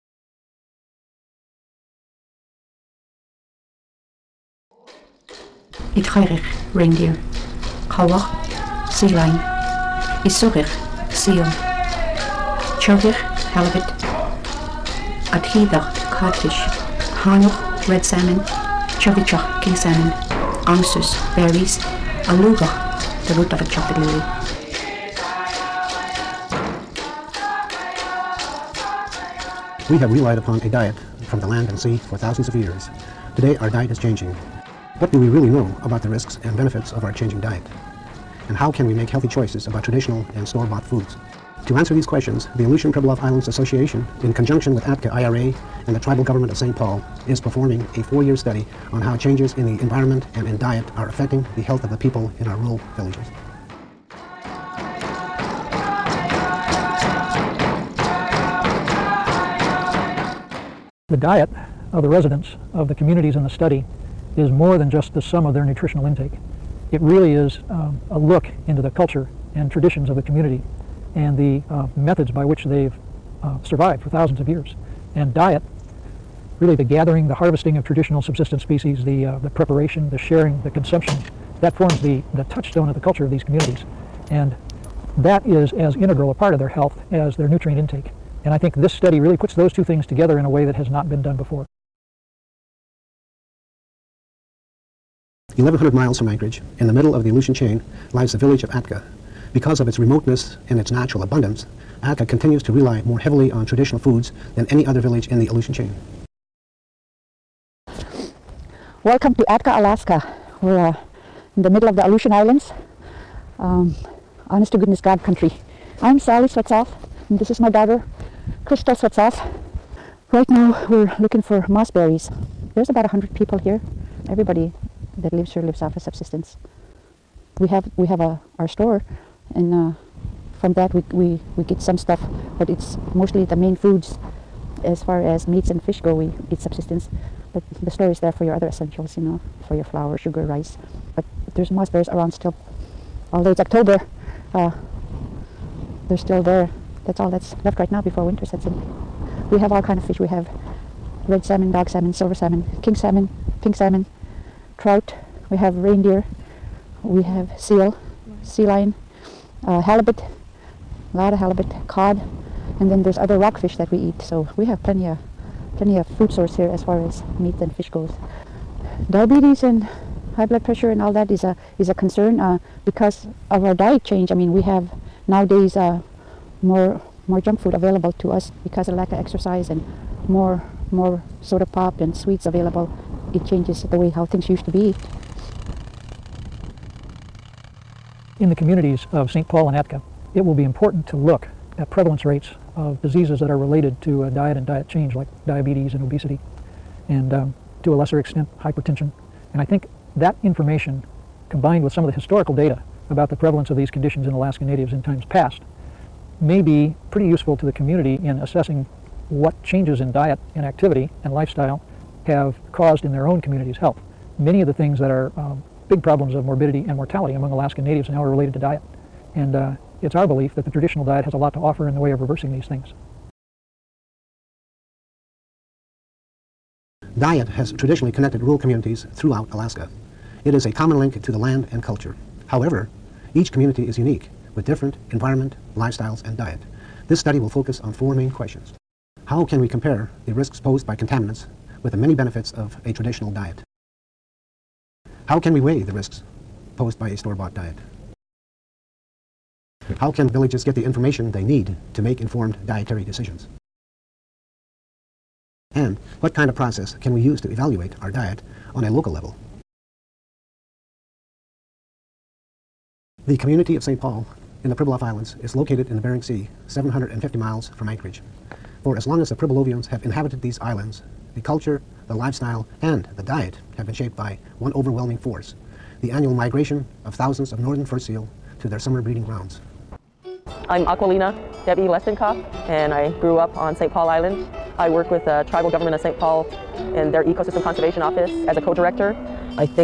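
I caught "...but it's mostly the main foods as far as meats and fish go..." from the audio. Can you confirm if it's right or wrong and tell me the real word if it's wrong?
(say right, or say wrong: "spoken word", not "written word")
right.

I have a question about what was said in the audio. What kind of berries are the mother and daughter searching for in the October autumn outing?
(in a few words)
Moss berries.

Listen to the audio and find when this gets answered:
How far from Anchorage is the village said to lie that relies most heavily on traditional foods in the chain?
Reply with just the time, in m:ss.
1:35.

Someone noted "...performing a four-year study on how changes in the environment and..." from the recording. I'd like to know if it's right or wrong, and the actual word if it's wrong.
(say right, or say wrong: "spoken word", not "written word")
right.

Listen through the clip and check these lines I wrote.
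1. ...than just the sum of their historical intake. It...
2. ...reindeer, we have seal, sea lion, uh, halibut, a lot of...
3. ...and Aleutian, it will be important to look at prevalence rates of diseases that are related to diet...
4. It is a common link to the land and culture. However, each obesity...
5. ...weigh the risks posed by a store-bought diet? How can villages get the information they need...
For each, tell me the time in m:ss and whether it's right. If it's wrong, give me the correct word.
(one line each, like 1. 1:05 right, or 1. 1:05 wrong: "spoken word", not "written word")
1. 1:04 wrong: "nutritional", not "historical"
2. 2:35 right
3. 3:09 wrong: "Atka", not "Aleutian"
4. 3:50 wrong: "community", not "obesity"
5. 4:05 right.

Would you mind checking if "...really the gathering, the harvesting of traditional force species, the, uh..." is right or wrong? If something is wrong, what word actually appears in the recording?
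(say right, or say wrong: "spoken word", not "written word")
wrong: "subsistence", not "force".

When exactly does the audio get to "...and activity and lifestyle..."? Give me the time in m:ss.
3:30.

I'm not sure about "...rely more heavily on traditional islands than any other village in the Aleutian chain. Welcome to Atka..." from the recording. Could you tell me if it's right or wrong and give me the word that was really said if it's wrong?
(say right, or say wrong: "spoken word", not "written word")
wrong: "foods", not "islands".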